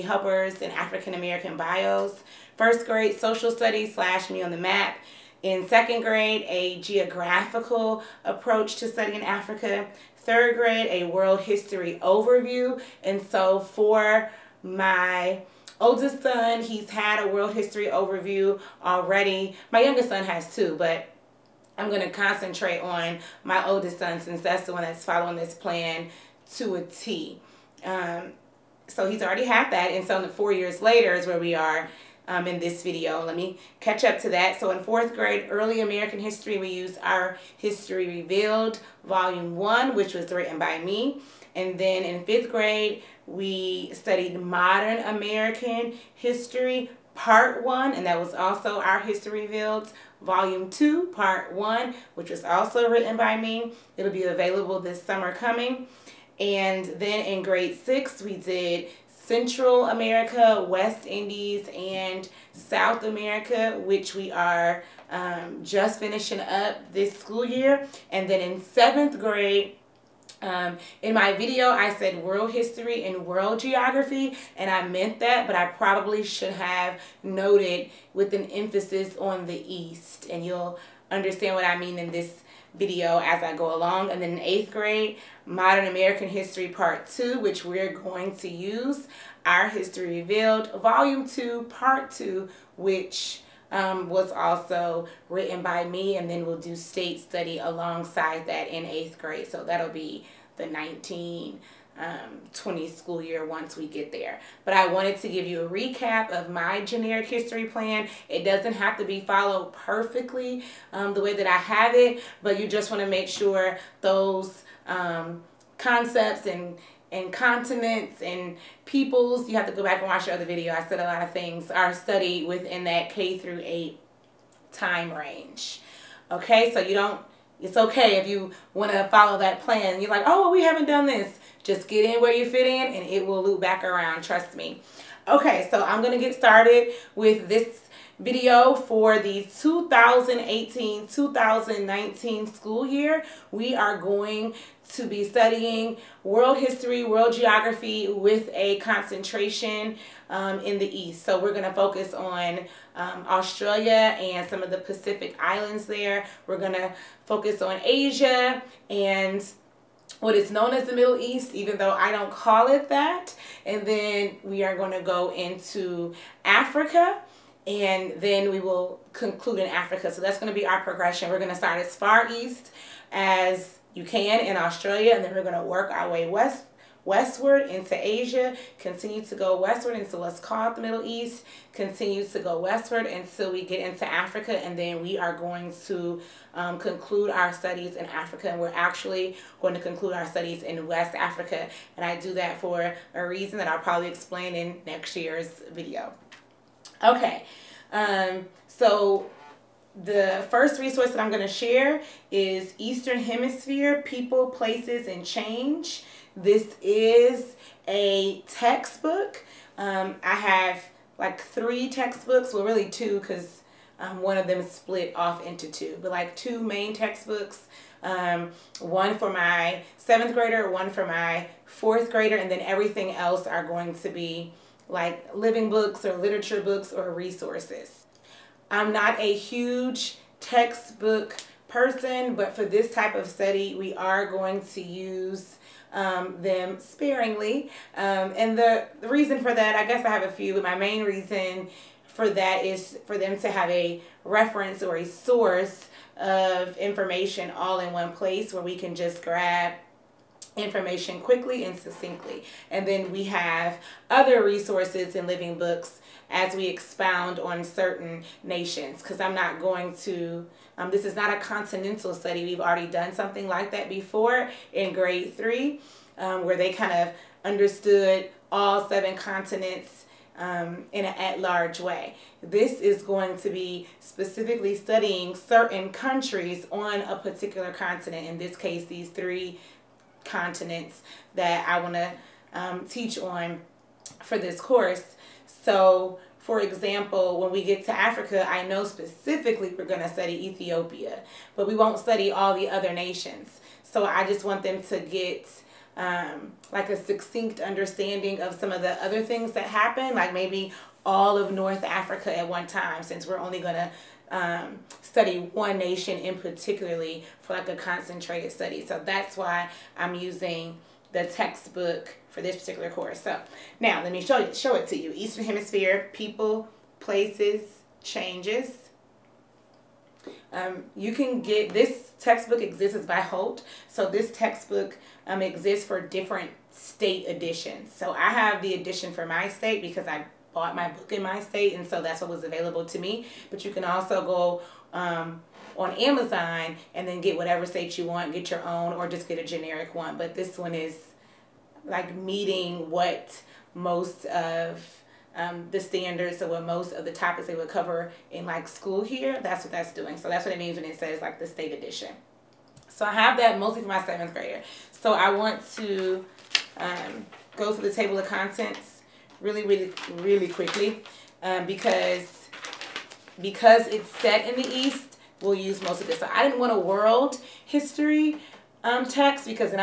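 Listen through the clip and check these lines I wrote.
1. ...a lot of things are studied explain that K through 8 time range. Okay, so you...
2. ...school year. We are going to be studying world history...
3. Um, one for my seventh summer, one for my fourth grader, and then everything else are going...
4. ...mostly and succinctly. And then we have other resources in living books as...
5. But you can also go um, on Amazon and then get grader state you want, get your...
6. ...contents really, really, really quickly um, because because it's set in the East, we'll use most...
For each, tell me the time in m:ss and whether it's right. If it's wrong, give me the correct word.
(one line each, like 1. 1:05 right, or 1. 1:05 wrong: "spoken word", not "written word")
1. 2:00 wrong: "within", not "explain"
2. 2:22 right
3. 3:38 wrong: "grader", not "summer"
4. 4:11 wrong: "quickly", not "mostly"
5. 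5:33 wrong: "whatever", not "grader"
6. 5:58 right.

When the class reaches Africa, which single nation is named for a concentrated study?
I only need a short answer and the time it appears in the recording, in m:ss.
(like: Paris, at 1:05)
Ethiopia, at 4:50.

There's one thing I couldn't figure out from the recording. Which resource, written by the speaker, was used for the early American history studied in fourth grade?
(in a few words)
History Revealed, Volume 1.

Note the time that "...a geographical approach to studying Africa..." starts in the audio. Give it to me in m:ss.
0:06.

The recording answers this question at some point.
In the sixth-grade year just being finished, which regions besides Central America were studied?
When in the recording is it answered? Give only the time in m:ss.
1:00.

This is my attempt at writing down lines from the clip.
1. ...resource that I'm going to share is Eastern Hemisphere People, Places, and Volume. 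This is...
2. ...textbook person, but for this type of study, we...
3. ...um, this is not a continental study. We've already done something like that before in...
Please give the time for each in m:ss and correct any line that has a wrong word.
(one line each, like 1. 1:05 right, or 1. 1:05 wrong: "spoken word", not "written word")
1. 3:20 wrong: "Change", not "Volume"
2. 3:50 right
3. 4:20 right.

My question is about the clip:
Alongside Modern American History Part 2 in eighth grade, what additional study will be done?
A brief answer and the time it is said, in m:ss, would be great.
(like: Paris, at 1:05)
State study, at 1:36.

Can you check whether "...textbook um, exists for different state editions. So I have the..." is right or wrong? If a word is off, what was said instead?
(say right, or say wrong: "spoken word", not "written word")
right.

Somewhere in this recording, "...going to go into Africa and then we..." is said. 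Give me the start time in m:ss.
2:44.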